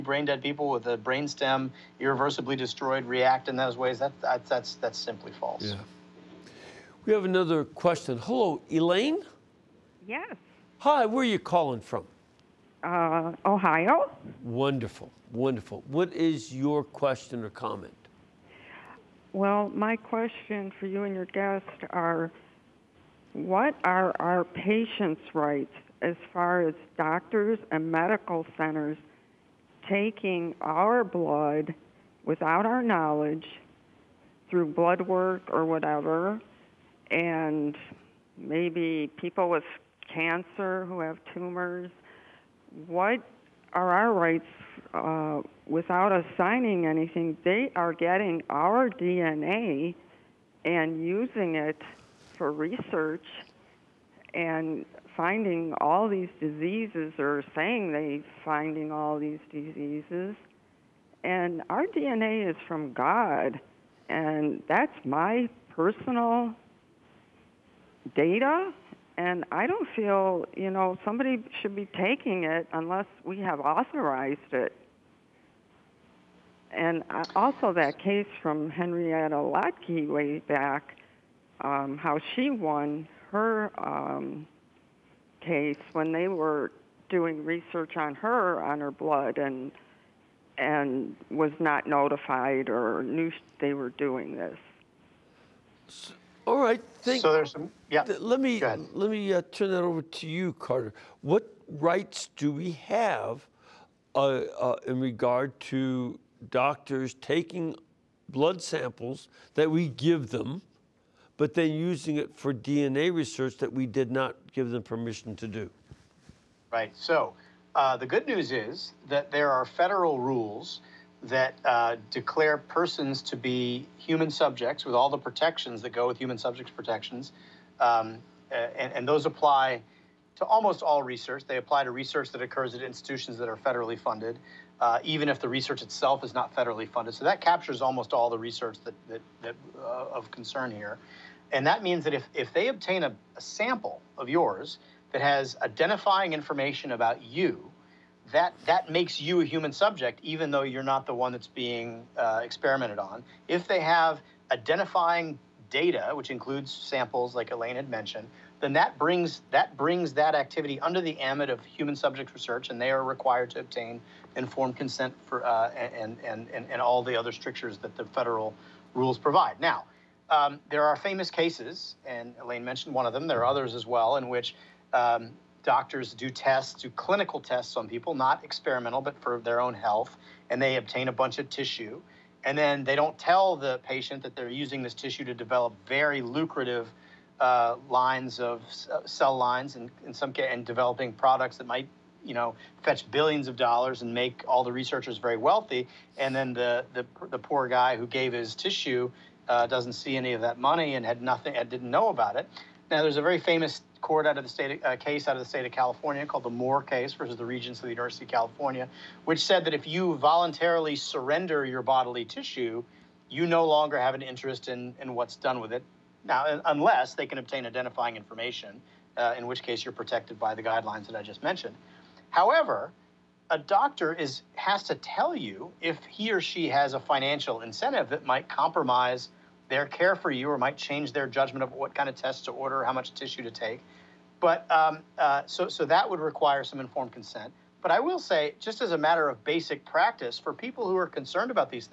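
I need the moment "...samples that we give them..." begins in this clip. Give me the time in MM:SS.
01:48.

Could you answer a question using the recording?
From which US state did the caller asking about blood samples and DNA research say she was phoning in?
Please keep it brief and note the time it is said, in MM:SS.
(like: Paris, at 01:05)
Ohio, at 00:13.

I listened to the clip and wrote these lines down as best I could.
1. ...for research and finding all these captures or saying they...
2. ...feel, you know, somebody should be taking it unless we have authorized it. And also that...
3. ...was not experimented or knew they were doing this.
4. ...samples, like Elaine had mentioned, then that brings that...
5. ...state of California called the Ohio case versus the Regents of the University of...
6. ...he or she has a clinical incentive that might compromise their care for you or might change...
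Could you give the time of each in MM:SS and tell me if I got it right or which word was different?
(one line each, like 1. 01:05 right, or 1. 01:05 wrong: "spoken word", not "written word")
1. 00:52 wrong: "diseases", not "captures"
2. 01:09 right
3. 01:31 wrong: "notified", not "experimented"
4. 02:36 right
5. 03:25 wrong: "Moore", not "Ohio"
6. 03:46 wrong: "financial", not "clinical".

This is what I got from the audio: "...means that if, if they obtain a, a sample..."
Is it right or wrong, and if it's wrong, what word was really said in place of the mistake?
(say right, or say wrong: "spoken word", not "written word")
right.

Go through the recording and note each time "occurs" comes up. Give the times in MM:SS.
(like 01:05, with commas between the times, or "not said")
02:12.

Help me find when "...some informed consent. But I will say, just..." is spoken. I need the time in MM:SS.
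03:56.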